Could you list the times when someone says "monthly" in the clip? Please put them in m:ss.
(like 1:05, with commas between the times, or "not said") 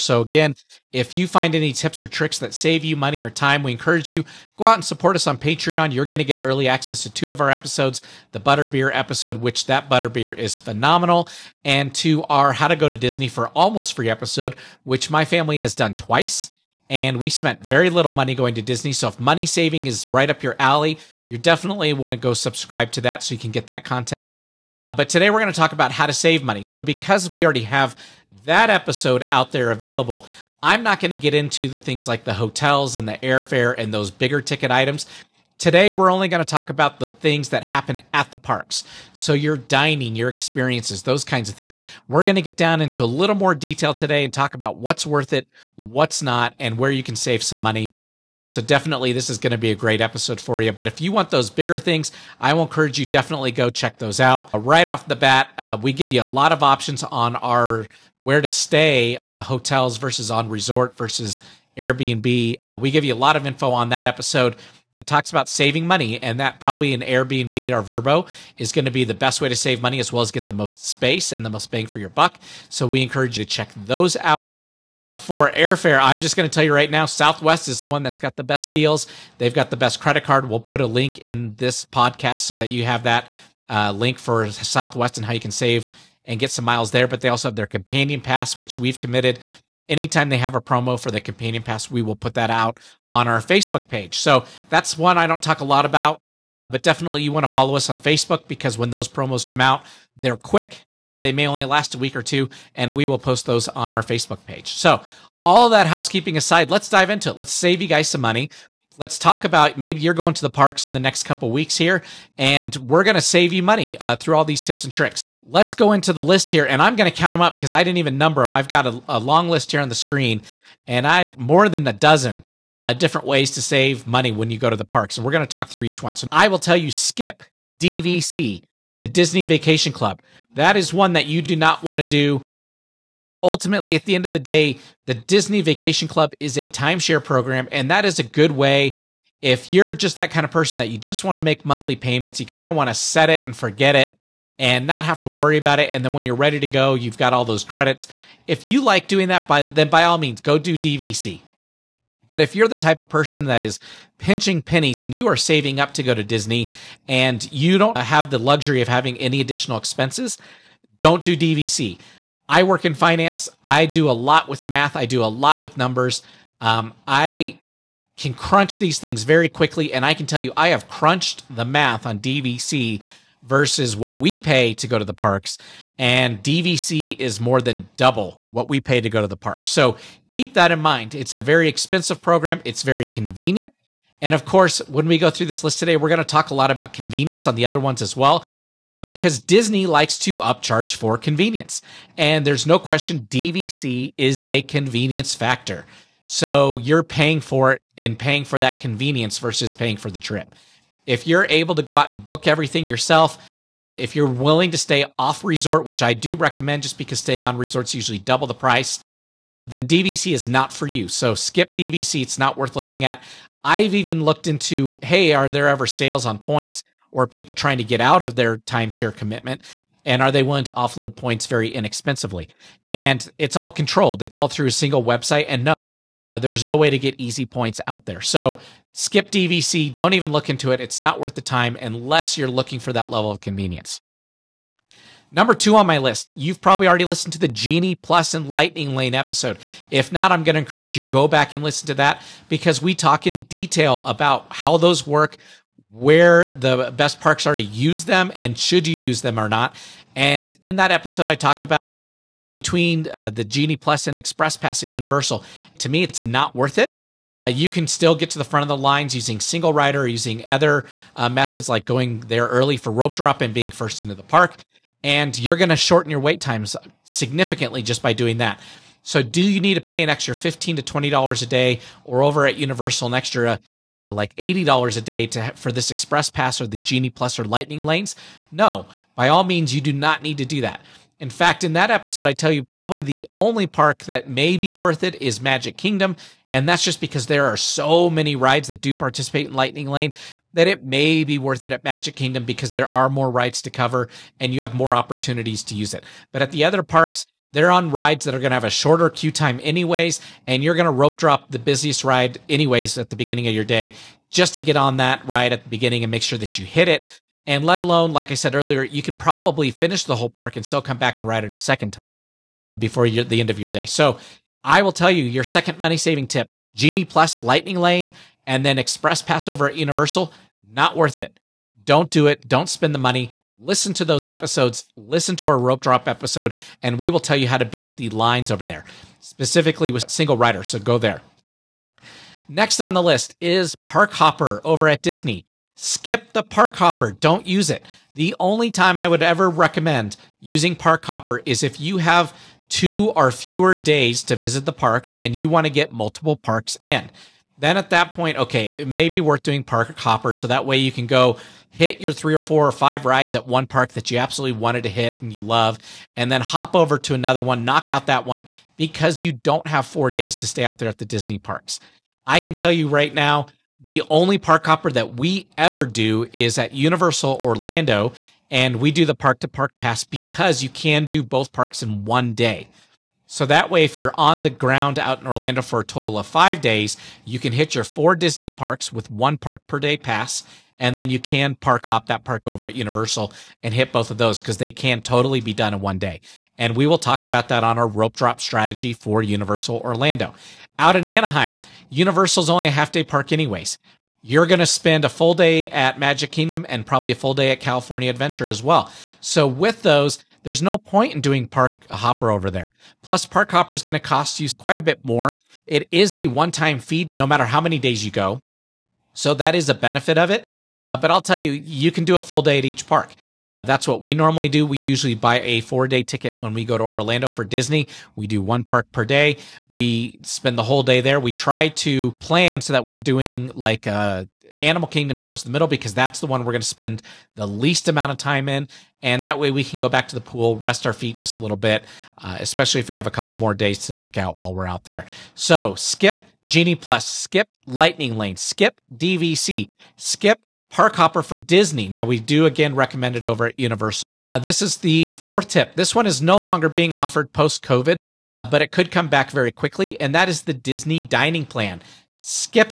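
2:21.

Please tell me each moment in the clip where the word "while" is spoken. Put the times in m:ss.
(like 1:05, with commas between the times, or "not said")
7:14.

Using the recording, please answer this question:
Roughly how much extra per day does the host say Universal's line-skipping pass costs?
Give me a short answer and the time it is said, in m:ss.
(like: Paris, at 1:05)
$80, at 4:34.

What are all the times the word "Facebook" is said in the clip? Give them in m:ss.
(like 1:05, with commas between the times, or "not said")
1:33, 1:37, 1:44.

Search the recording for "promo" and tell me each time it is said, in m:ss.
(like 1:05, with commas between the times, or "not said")
1:30, 1:39.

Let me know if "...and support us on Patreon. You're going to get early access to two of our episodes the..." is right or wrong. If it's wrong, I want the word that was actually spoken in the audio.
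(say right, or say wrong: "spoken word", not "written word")
right.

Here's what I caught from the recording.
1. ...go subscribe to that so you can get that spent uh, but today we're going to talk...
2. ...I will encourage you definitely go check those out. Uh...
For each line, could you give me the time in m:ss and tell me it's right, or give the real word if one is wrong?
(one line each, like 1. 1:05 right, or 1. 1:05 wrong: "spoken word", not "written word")
1. 0:22 wrong: "content", not "spent"
2. 0:52 right.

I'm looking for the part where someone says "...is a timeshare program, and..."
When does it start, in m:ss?
2:16.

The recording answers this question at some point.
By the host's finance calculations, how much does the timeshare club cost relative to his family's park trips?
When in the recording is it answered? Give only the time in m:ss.
2:57.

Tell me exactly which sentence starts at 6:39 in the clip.
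So, with those, there's no point in doing Park Hopper over there.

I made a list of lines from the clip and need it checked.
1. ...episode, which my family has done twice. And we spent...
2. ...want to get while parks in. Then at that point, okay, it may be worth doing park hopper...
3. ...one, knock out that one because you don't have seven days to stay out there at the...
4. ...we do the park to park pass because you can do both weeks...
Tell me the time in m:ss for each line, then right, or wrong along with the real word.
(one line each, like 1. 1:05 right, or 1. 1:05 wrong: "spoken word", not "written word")
1. 0:14 right
2. 5:45 wrong: "multiple", not "while"
3. 5:57 wrong: "four", not "seven"
4. 6:08 wrong: "parks", not "weeks".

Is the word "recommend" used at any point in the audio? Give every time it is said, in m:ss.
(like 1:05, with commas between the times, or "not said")
3:26, 5:39, 7:22.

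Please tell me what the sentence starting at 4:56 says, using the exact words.
But at the other parks, they're on rides that are going to have a shorter queue time, anyways.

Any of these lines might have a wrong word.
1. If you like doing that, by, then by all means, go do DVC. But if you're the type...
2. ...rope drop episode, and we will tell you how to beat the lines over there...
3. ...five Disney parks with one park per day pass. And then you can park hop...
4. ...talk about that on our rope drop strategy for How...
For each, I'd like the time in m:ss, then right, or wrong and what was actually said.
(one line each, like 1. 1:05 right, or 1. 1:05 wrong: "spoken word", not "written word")
1. 2:28 right
2. 5:25 right
3. 6:17 wrong: "four", not "five"
4. 6:26 wrong: "Universal", not "How".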